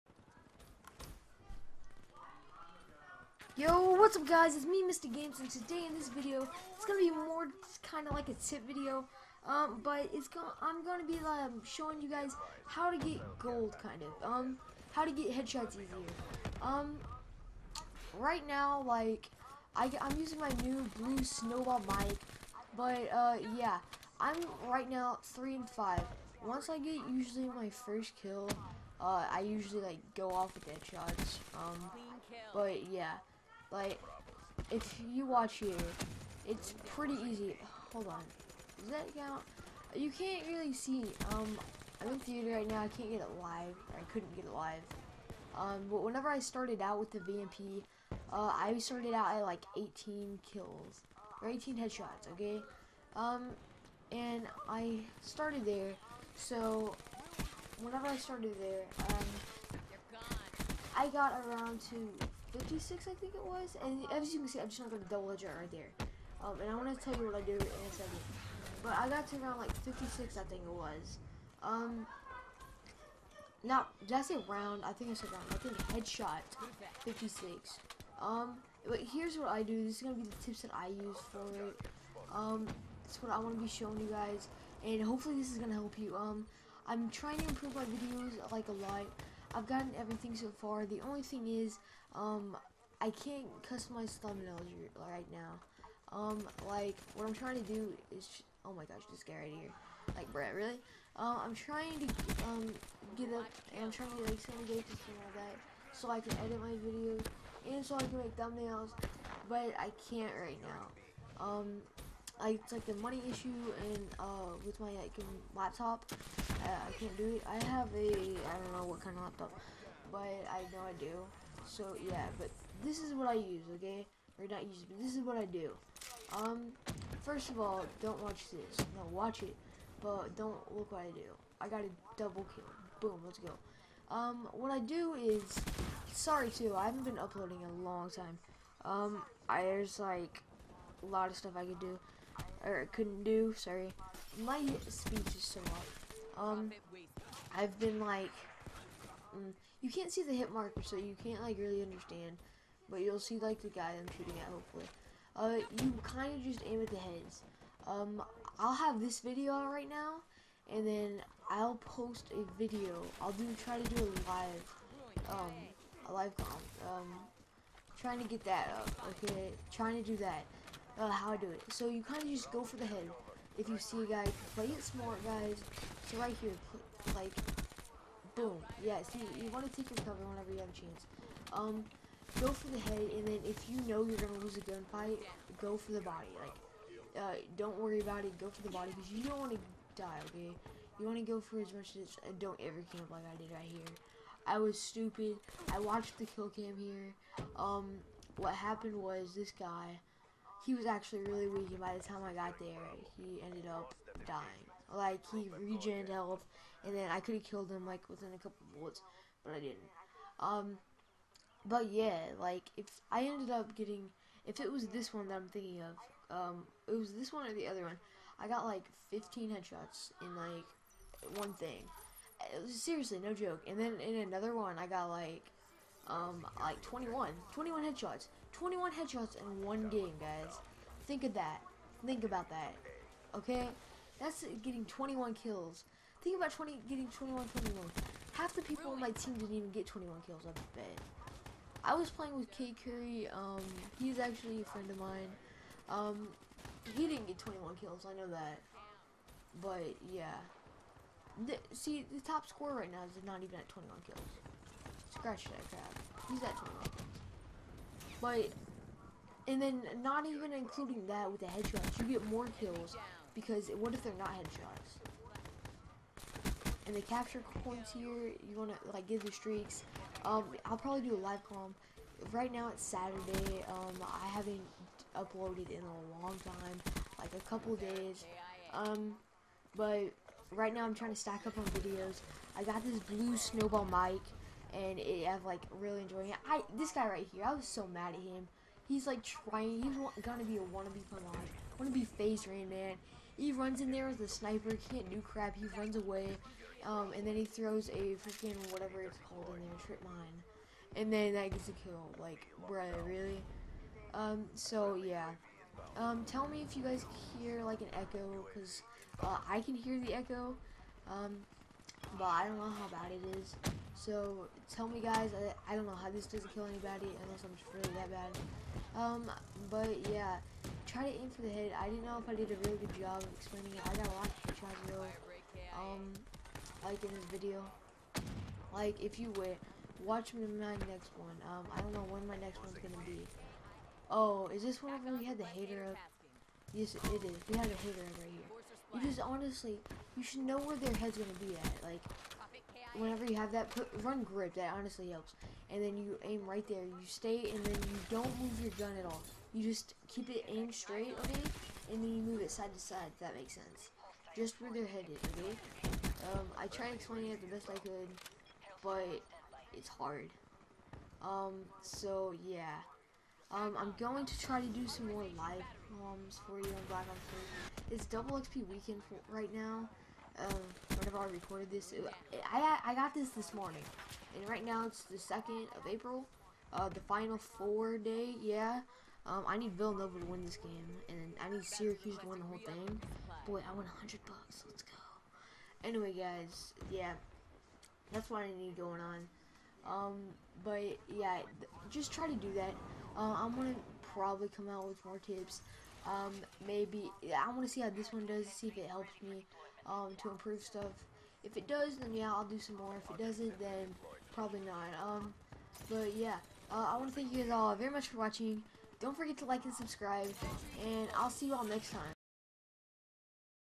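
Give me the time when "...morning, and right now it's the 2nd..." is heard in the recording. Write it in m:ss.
6:13.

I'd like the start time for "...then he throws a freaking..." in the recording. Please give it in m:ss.
4:57.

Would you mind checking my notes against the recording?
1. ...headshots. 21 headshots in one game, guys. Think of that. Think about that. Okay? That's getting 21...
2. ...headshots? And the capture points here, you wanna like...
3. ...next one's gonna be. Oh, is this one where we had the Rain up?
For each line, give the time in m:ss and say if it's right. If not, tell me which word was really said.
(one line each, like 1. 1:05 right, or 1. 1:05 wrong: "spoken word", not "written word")
1. 3:47 right
2. 4:24 right
3. 5:32 wrong: "HATR", not "Rain".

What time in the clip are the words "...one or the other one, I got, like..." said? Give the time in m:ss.
3:37.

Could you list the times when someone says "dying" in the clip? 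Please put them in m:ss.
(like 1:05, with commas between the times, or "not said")
3:24.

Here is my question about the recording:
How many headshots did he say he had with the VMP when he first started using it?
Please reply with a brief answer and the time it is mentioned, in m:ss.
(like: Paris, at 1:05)
18, at 0:51.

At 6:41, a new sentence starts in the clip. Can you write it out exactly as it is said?
If it does, then yeah, I'll do some more.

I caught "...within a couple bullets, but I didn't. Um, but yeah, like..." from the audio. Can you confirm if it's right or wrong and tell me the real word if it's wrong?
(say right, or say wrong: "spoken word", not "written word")
right.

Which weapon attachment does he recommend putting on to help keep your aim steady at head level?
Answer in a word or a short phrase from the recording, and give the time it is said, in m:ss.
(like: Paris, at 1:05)
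run grip, at 5:44.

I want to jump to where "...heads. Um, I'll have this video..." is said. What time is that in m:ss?
2:36.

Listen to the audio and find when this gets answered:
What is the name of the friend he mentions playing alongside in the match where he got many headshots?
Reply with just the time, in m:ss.
4:02.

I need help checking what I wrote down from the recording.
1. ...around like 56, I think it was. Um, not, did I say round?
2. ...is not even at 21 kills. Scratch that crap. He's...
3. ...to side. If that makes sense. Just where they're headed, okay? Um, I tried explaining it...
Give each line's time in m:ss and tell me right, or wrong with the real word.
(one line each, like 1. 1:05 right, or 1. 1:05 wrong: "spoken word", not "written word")
1. 1:09 right
2. 4:13 right
3. 5:52 right.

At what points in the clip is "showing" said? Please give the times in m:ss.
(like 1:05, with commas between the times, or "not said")
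0:11, 1:23.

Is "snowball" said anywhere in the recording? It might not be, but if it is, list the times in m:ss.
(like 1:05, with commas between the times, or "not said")
0:21, 4:43.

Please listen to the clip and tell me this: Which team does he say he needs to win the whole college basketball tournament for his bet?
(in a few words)
Syracuse.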